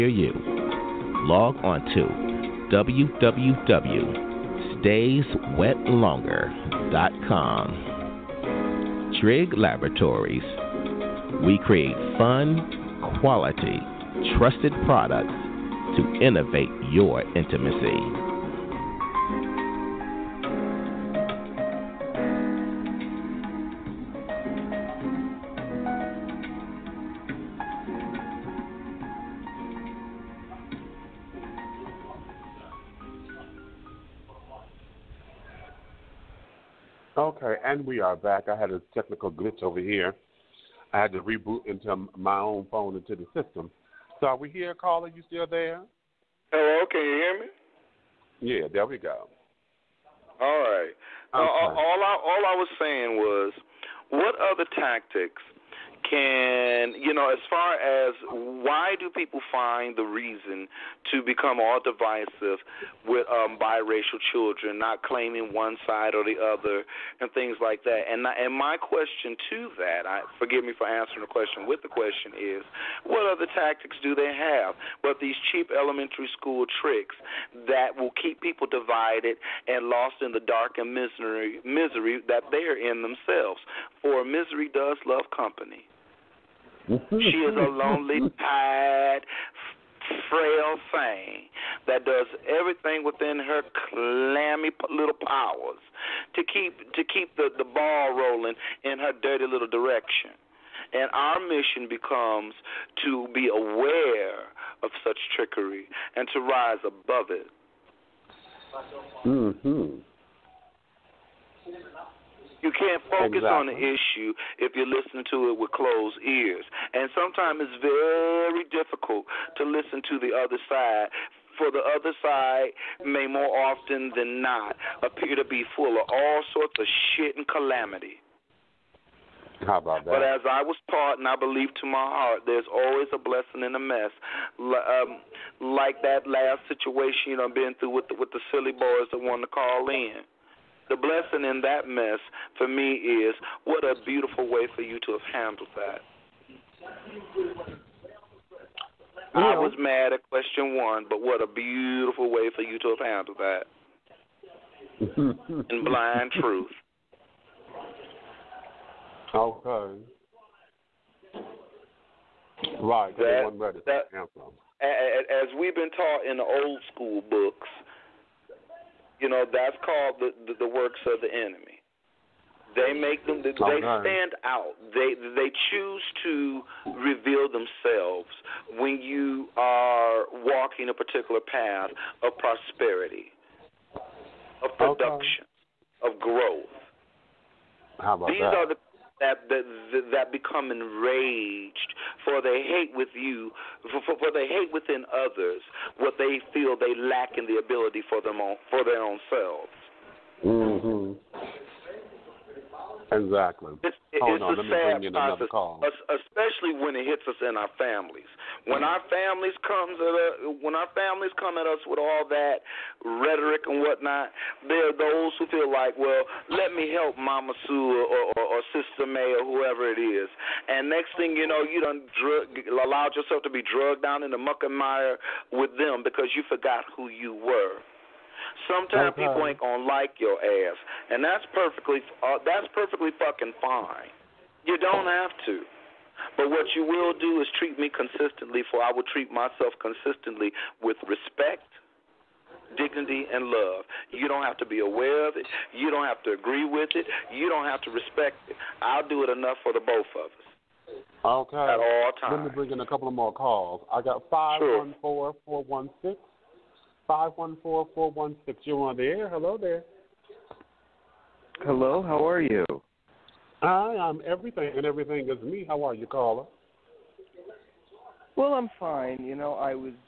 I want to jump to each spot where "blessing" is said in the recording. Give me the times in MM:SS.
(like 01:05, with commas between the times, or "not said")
02:13, 02:20.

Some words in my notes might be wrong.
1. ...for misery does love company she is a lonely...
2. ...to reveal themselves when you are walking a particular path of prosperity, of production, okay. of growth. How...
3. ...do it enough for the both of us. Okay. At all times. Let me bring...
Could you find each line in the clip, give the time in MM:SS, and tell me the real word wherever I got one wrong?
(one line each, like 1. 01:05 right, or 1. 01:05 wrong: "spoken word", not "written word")
1. 01:24 right
2. 02:56 right
3. 04:09 right.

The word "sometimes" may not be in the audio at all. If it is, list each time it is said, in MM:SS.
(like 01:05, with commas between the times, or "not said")
01:57, 03:48.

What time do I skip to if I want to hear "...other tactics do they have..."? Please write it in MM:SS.
01:13.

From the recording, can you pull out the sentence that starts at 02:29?
I was mad at question one, but what a beautiful way for you to have handled that.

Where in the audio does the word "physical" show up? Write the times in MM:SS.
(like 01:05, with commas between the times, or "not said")
not said.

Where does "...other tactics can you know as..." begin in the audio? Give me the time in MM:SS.
00:54.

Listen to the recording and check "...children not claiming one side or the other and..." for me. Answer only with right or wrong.
right.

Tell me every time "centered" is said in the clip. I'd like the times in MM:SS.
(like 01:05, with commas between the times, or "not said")
not said.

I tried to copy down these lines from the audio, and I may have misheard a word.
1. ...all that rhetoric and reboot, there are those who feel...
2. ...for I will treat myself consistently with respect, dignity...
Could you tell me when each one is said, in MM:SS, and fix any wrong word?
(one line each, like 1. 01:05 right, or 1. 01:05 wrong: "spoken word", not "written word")
1. 03:31 wrong: "whatnot", not "reboot"
2. 03:58 right.